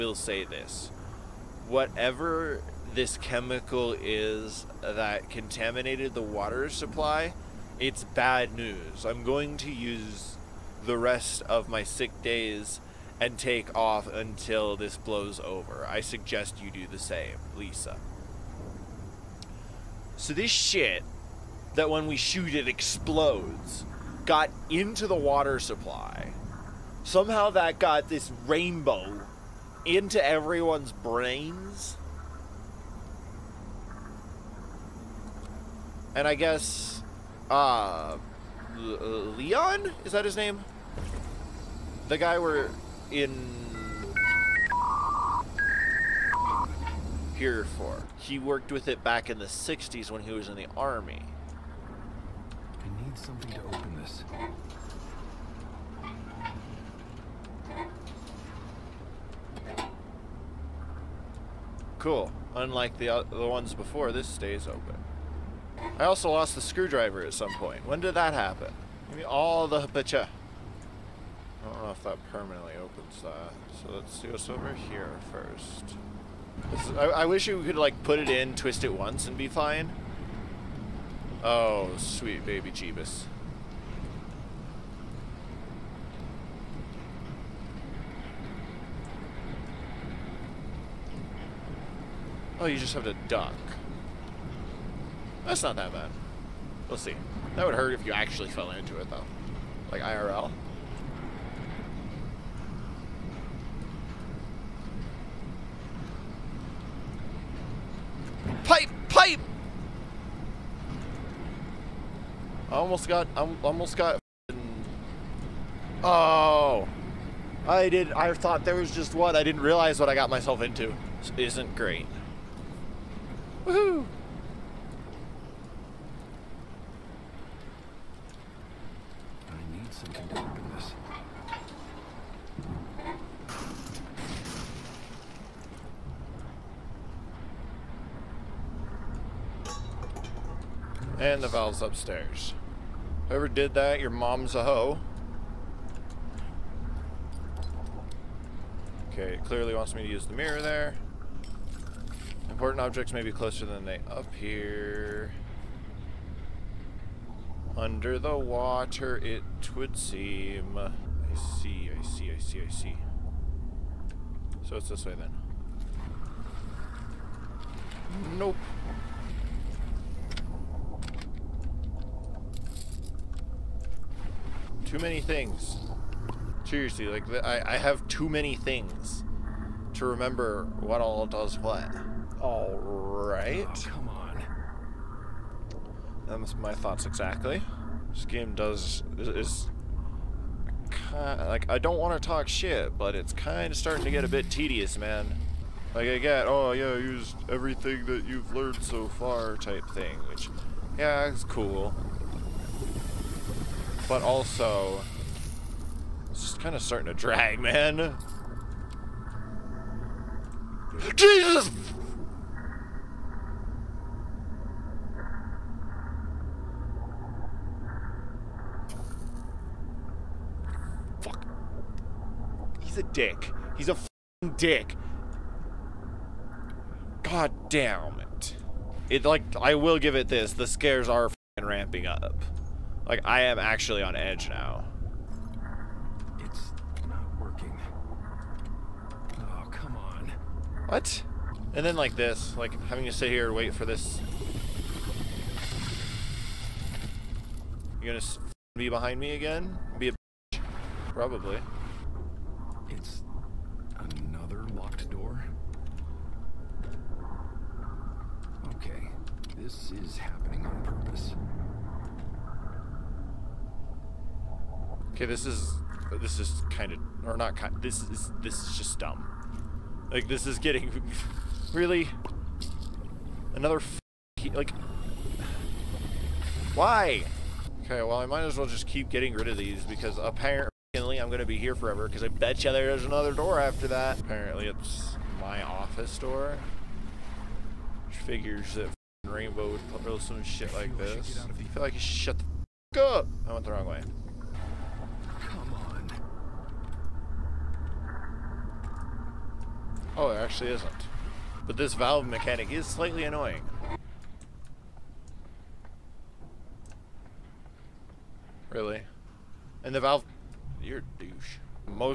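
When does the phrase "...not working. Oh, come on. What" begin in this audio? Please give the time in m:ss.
3:57.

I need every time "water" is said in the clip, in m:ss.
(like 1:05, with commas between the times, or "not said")
0:06, 0:25, 2:38.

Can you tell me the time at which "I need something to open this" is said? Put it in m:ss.
0:52.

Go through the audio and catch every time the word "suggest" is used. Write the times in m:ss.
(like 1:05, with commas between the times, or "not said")
0:16.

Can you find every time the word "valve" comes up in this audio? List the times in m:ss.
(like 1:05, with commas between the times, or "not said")
2:21, 5:01, 5:10.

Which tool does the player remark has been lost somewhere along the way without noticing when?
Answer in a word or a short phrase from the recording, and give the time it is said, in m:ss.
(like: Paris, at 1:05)
screwdriver, at 1:06.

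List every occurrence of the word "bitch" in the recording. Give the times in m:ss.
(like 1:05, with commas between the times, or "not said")
4:10.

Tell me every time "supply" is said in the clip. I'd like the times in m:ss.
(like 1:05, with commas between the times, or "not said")
0:06, 0:25.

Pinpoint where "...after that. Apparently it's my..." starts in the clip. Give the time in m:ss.
4:43.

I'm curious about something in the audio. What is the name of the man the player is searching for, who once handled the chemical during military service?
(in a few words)
Leon.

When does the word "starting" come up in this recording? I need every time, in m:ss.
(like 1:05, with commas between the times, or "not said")
3:13, 3:26.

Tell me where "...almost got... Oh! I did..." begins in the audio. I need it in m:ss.
1:53.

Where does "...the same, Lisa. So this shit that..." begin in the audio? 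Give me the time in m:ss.
0:16.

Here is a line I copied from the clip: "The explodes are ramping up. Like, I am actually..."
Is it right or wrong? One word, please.
wrong.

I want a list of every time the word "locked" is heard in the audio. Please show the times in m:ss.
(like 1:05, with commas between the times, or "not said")
4:14.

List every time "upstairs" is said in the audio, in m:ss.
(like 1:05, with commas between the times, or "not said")
2:21.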